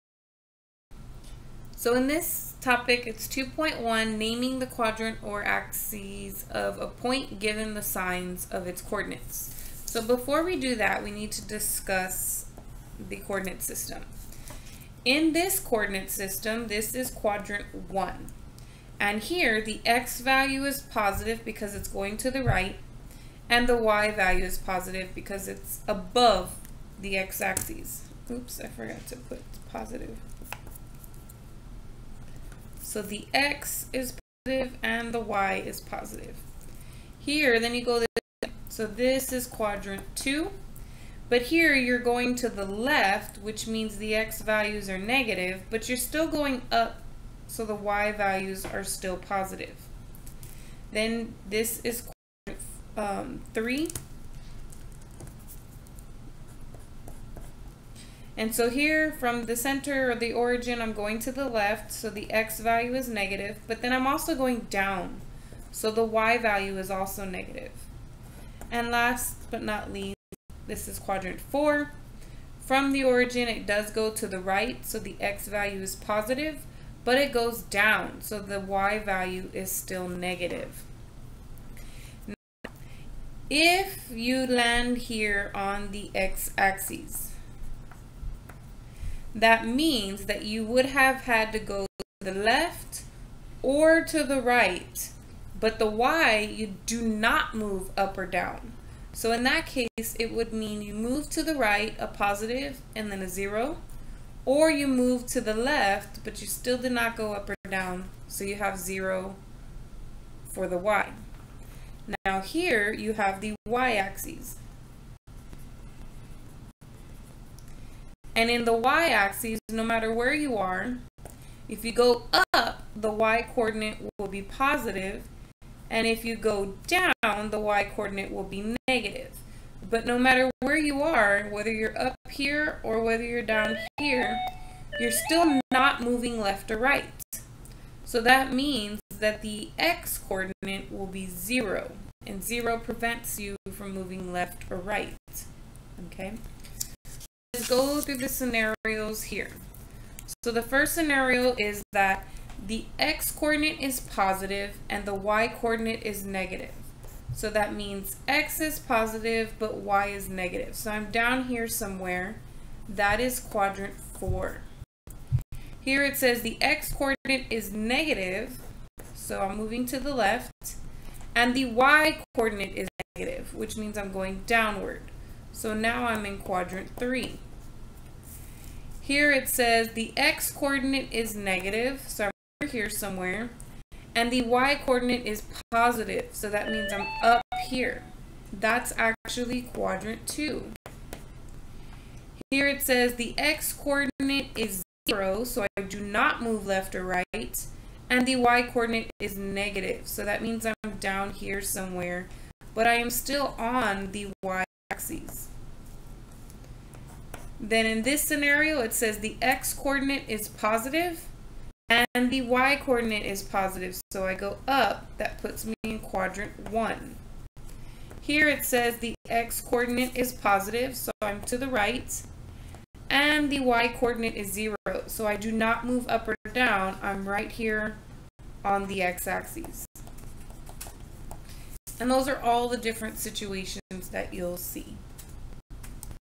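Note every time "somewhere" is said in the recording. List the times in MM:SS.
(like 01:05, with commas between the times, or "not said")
02:41, 03:02, 03:21.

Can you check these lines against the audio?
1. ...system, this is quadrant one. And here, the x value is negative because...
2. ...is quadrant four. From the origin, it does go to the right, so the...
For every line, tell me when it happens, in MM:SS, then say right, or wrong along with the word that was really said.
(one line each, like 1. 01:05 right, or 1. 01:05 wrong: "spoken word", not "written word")
1. 00:16 wrong: "positive", not "negative"
2. 01:10 right.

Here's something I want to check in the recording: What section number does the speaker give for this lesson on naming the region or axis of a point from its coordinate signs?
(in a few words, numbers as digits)
2.1.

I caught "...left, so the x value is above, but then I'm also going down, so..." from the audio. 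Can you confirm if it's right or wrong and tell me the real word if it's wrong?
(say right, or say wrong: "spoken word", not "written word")
wrong: "negative", not "above".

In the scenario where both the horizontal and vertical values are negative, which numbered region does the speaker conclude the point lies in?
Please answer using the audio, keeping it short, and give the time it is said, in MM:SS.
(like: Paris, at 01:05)
quadrant 3, at 02:56.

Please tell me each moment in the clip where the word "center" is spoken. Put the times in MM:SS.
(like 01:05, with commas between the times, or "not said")
00:59.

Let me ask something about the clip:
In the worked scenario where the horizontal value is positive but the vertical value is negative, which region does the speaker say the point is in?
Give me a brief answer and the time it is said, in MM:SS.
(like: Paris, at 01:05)
quadrant 4, at 02:43.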